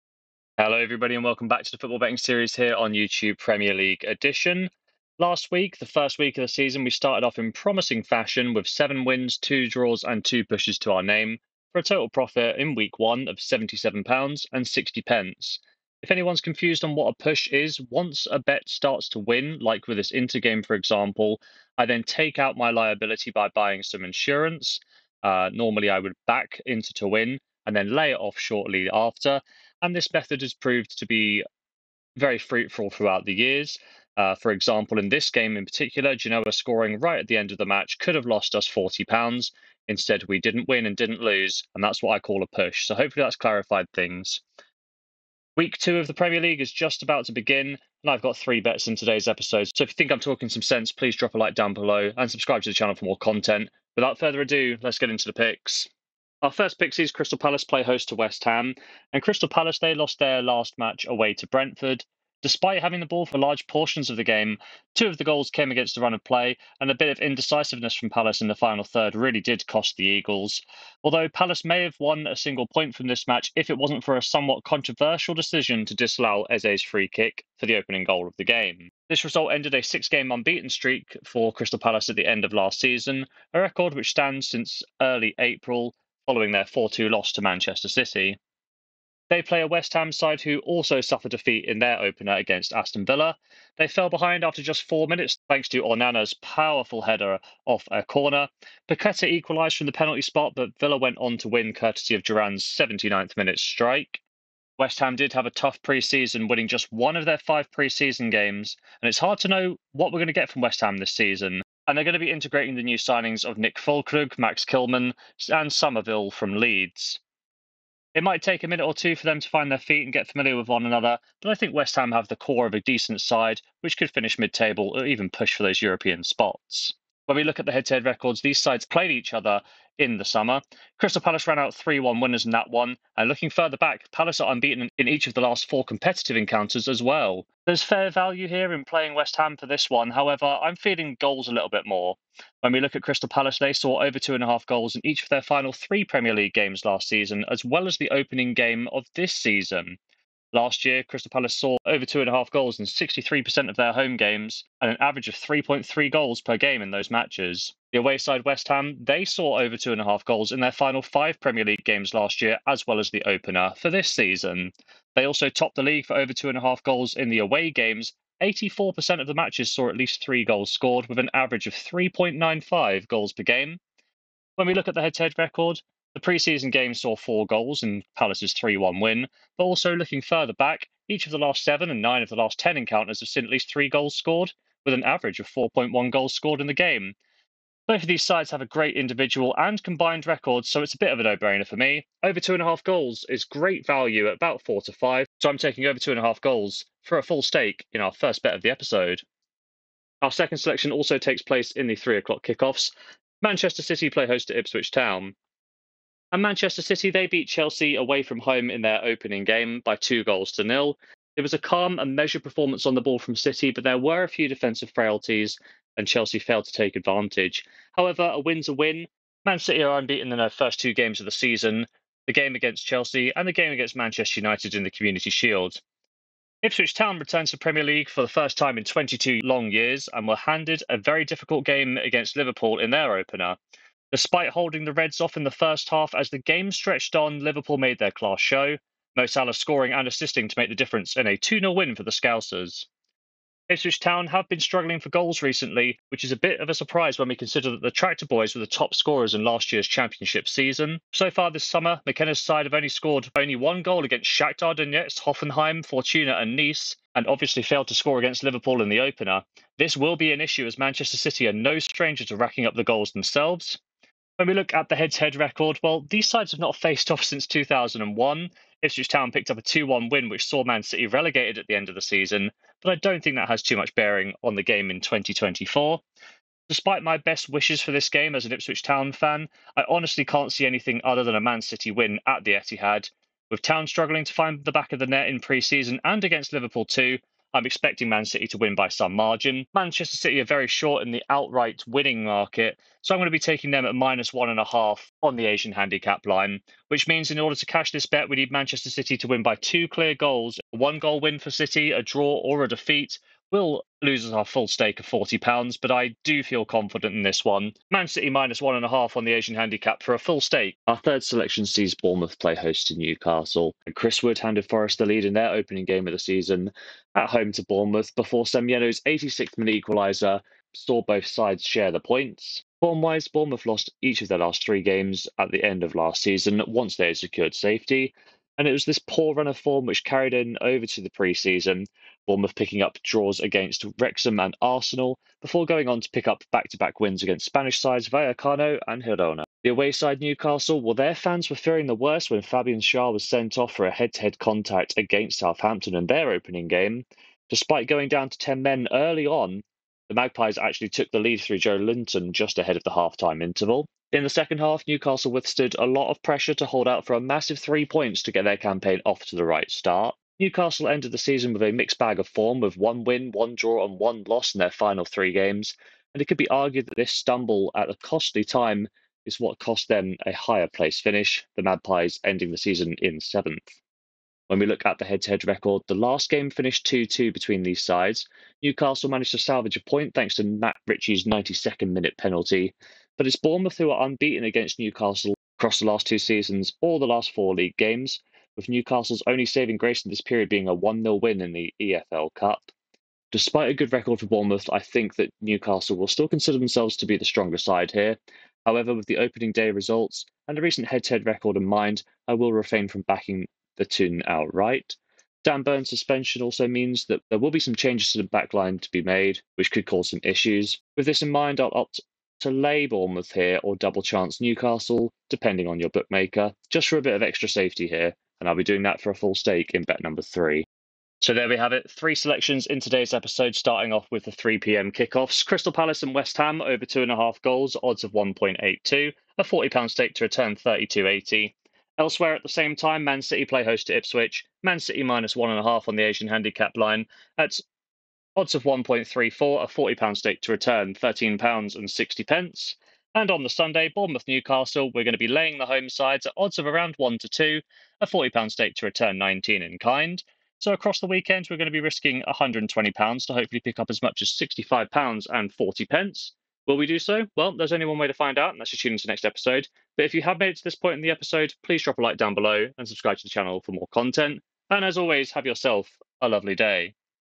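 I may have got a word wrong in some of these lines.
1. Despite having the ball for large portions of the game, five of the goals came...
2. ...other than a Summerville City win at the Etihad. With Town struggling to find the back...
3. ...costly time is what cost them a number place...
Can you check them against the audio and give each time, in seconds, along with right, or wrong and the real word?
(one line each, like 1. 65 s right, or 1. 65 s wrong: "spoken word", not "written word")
1. 62 s wrong: "two", not "five"
2. 281 s wrong: "Man", not "Summerville"
3. 367 s wrong: "higher", not "number".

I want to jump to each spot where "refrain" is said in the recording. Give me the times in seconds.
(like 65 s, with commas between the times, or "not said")
402 s.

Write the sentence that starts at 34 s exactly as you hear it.
Uh, for example, in this game in particular, Genoa scoring right at the end of the match could have lost us £40.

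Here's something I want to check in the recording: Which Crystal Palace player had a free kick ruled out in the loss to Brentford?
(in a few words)
Eze.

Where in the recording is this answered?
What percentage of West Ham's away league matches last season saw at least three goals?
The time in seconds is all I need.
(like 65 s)
168 s.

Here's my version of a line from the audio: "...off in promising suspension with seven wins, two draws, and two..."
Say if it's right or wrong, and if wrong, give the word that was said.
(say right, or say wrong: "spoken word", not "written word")
wrong: "fashion", not "suspension".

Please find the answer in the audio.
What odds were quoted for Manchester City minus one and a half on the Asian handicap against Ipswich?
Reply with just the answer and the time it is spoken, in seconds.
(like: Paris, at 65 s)
1.34, at 438 s.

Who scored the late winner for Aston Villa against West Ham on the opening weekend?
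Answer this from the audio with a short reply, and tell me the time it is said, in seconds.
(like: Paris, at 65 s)
Duran, at 102 s.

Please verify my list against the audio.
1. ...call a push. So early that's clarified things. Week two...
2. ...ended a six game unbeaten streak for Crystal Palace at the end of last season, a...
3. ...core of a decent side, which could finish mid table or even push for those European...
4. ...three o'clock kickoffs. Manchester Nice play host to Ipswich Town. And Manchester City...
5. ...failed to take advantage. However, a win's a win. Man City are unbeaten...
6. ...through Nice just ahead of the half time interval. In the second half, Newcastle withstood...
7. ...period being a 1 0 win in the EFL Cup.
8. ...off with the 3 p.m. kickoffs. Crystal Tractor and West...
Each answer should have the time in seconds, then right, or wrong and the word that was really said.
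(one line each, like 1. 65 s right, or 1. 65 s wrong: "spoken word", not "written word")
1. 42 s wrong: "hopefully", not "early"
2. 79 s right
3. 122 s right
4. 201 s wrong: "City", not "Nice"
5. 216 s right
6. 351 s wrong: "Joelinton", not "Nice"
7. 390 s right
8. 423 s wrong: "Palace", not "Tractor".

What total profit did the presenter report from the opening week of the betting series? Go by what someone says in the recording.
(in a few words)
£77.60.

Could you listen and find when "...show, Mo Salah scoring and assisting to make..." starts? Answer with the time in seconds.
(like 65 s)
238 s.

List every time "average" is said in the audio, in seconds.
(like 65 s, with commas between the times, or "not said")
154 s, 171 s, 185 s.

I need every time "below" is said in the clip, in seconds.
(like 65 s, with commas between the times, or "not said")
51 s, 462 s.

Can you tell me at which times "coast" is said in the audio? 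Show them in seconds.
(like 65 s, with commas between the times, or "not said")
not said.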